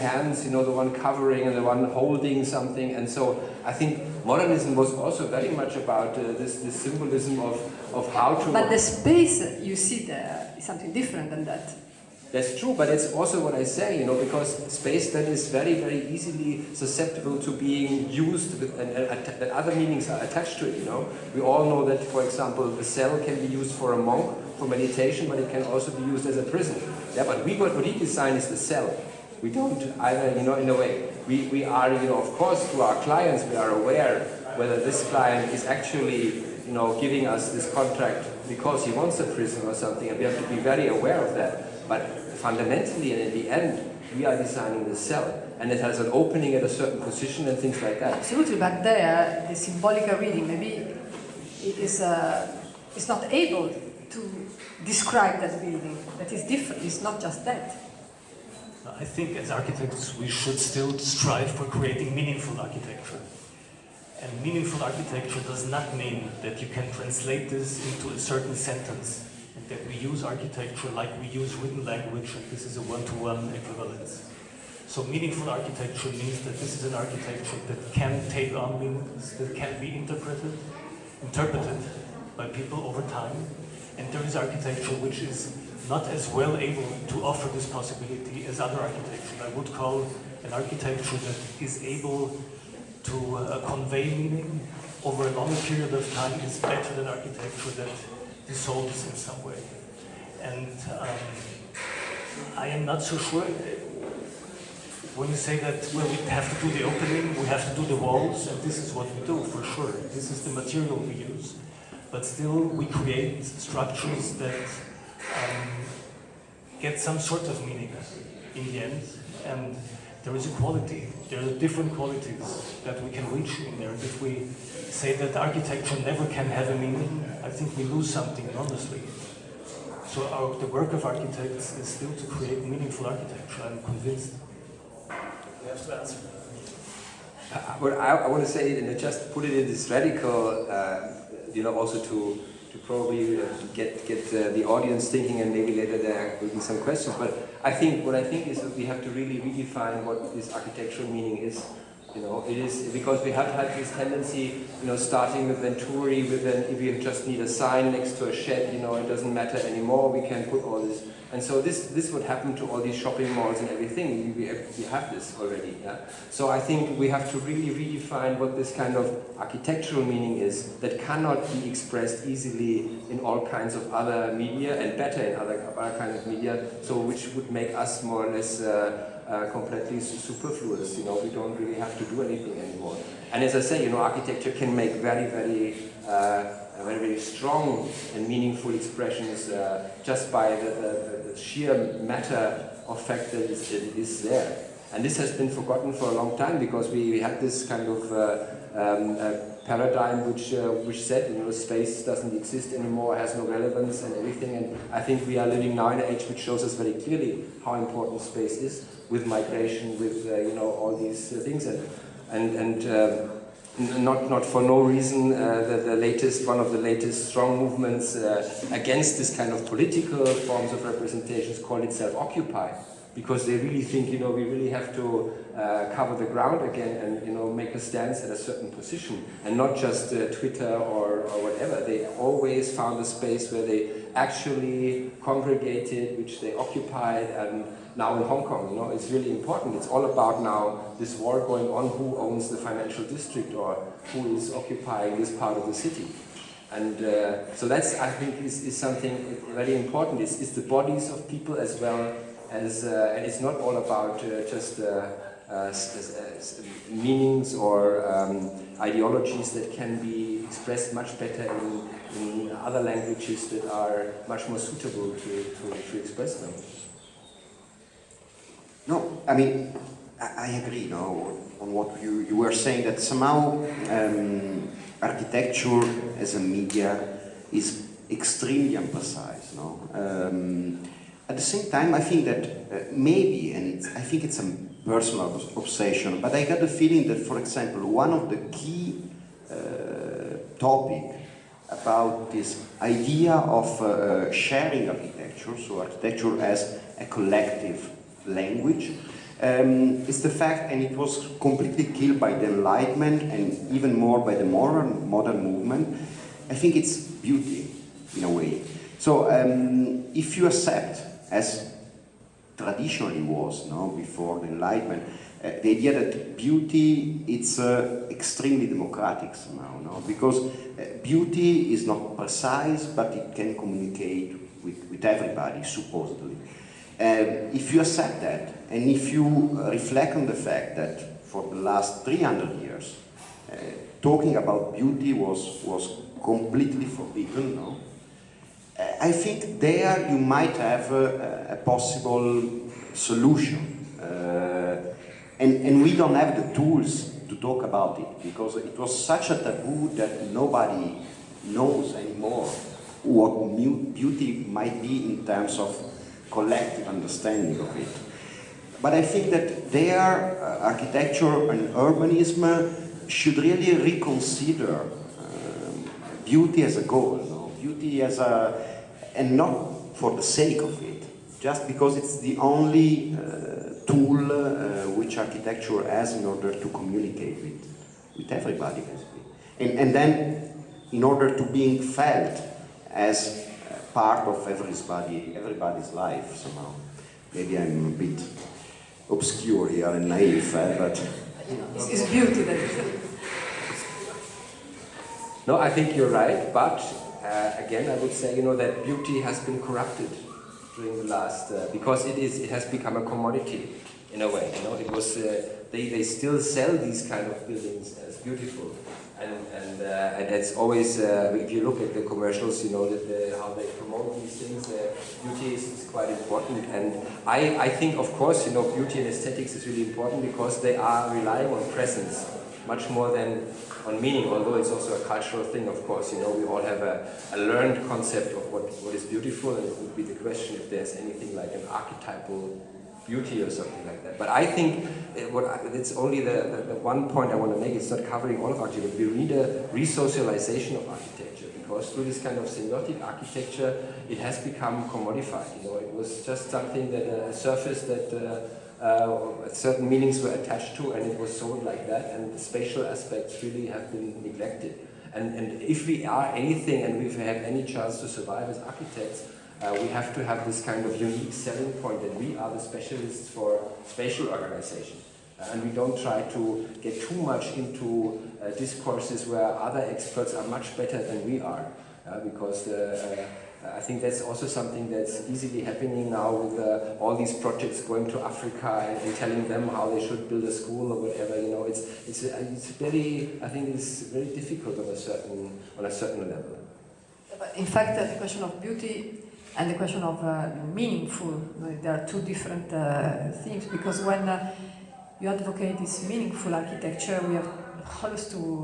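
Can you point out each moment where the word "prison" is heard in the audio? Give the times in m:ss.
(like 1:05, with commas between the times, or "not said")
0:26, 0:39.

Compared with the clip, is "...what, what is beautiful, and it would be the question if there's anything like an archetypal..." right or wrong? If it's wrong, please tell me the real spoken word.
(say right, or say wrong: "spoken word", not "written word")
right.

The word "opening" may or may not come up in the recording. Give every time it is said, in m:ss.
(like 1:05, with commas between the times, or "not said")
0:46, 1:46.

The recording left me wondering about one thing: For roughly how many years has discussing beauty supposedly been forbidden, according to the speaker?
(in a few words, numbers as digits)
300.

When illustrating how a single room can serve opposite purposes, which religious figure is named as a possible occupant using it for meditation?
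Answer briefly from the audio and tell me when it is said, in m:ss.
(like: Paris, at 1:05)
a monk, at 0:23.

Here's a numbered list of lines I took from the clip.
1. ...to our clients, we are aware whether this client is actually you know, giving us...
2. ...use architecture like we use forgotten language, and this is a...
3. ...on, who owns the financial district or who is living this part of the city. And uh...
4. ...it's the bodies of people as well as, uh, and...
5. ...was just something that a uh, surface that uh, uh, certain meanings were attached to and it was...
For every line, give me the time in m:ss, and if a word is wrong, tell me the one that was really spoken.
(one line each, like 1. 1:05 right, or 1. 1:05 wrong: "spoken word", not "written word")
1. 0:32 right
2. 1:09 wrong: "written", not "forgotten"
3. 4:01 wrong: "occupying", not "living"
4. 4:10 right
5. 7:25 right.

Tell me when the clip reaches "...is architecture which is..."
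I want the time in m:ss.
1:24.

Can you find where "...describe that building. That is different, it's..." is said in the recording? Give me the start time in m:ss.
0:54.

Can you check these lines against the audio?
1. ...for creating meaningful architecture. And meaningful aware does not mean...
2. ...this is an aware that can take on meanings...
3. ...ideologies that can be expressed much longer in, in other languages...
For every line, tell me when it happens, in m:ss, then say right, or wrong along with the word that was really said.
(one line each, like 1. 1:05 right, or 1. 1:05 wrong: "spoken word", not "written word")
1. 1:01 wrong: "architecture", not "aware"
2. 1:16 wrong: "architecture", not "aware"
3. 4:18 wrong: "better", not "longer".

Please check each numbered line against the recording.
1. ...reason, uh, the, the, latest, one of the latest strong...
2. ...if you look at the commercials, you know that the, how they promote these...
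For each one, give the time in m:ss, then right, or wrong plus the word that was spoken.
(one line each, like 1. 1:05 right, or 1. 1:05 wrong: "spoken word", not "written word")
1. 3:34 right
2. 6:51 right.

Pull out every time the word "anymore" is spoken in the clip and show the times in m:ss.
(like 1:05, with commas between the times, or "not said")
2:39, 3:02, 3:22, 5:51.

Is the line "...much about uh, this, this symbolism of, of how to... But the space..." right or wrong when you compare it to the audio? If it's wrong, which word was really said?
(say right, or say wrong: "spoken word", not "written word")
right.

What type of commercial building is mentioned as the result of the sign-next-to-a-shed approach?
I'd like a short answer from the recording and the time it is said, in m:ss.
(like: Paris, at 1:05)
shopping malls, at 2:42.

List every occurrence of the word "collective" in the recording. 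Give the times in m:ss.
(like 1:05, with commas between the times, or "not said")
4:57, 5:56.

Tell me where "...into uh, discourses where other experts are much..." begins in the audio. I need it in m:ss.
7:47.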